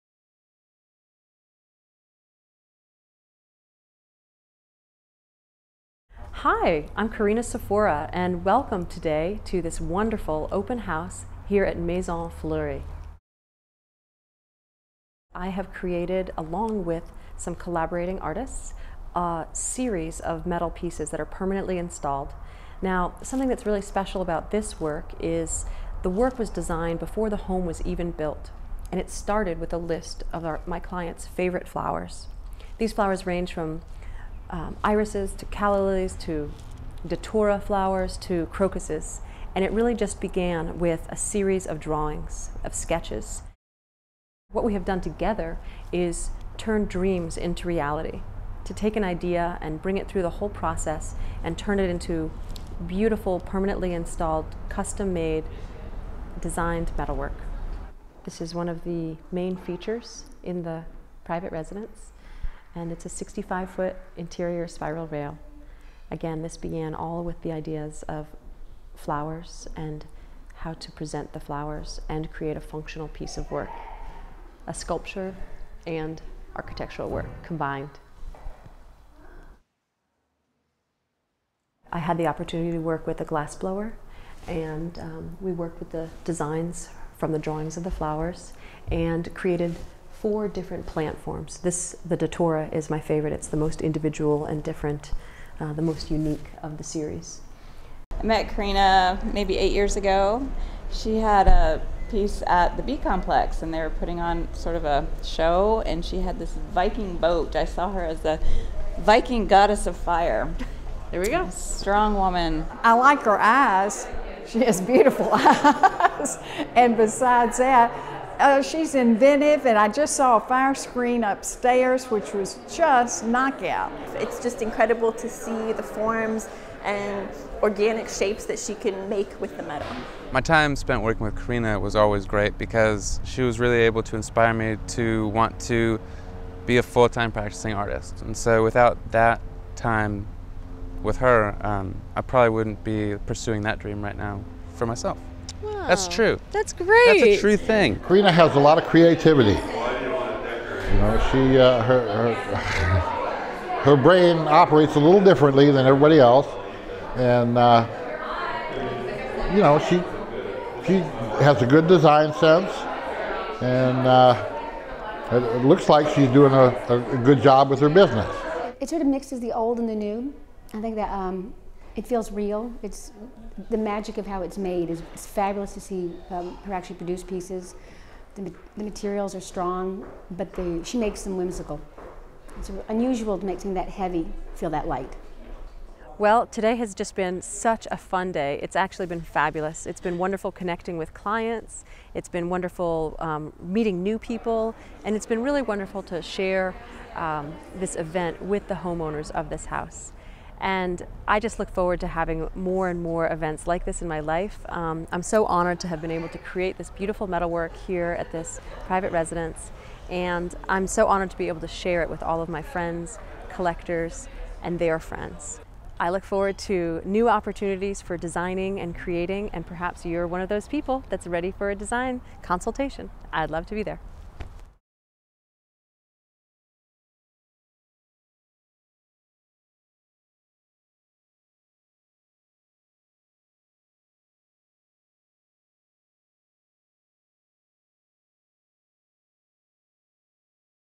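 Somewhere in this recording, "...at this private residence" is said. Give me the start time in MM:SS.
03:28.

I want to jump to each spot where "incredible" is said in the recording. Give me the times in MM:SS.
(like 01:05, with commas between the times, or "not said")
02:04.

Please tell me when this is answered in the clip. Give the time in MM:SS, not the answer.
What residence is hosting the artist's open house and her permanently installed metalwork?
00:11.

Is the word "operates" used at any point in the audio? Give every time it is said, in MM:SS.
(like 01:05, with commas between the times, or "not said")
02:34.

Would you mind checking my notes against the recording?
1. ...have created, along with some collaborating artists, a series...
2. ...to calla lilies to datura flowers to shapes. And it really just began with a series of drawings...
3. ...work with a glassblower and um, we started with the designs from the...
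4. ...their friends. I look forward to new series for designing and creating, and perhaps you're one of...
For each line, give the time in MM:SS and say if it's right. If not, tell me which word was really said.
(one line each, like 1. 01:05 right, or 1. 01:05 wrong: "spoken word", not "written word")
1. 00:15 right
2. 00:35 wrong: "crocuses", not "shapes"
3. 01:22 wrong: "worked", not "started"
4. 03:34 wrong: "opportunities", not "series".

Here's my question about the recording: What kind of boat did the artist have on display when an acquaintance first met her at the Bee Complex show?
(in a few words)
Viking boat.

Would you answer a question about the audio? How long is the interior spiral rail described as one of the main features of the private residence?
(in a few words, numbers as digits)
65 feet.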